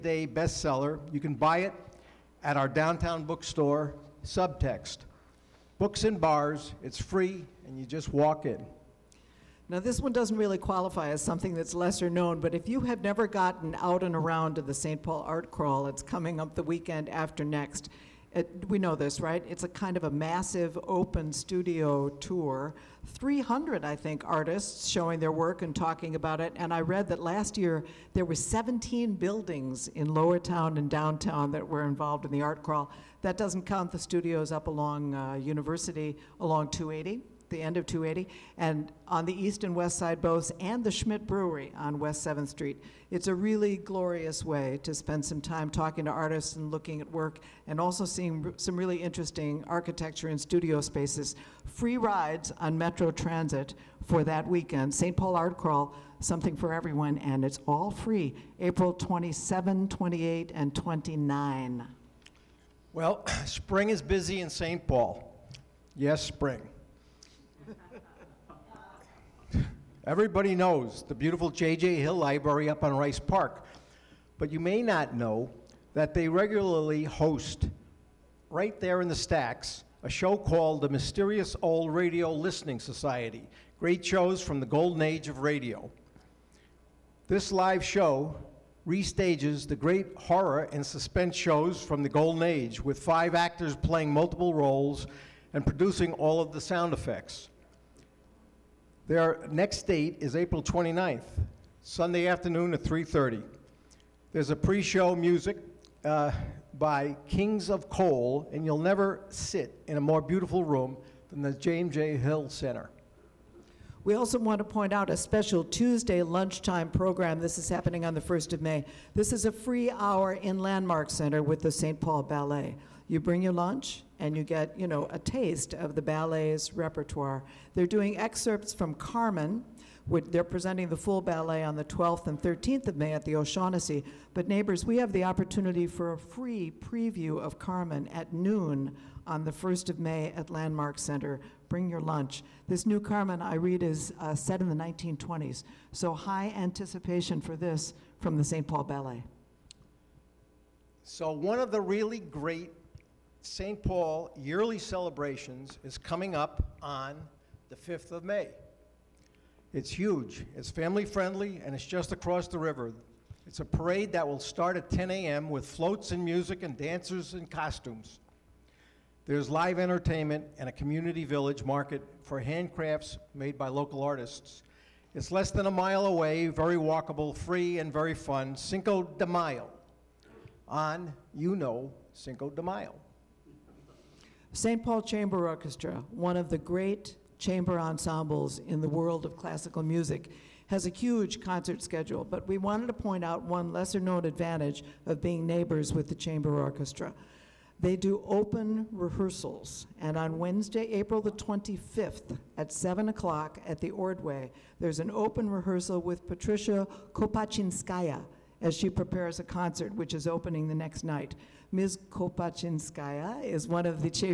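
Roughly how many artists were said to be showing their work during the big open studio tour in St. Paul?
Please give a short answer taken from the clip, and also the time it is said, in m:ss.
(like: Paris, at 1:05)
300, at 0:23.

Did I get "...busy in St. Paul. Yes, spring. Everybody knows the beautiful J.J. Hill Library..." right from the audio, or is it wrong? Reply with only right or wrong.
right.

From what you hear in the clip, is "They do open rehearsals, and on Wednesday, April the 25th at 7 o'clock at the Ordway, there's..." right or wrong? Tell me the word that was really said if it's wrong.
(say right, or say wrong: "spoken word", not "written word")
right.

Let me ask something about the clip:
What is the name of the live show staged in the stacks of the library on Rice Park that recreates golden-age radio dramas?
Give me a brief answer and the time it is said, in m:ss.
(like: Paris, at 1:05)
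Mysterious Old Radio Listening Society, at 1:20.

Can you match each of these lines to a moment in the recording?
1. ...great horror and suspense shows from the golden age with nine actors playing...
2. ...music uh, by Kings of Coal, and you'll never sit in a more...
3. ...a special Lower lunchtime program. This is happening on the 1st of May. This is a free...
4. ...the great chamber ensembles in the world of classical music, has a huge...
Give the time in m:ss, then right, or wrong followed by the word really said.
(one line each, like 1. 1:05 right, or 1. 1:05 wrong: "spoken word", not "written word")
1. 1:29 wrong: "five", not "nine"
2. 1:45 right
3. 1:55 wrong: "Tuesday", not "Lower"
4. 3:06 right.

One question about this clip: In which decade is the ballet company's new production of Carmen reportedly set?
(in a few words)
1920s.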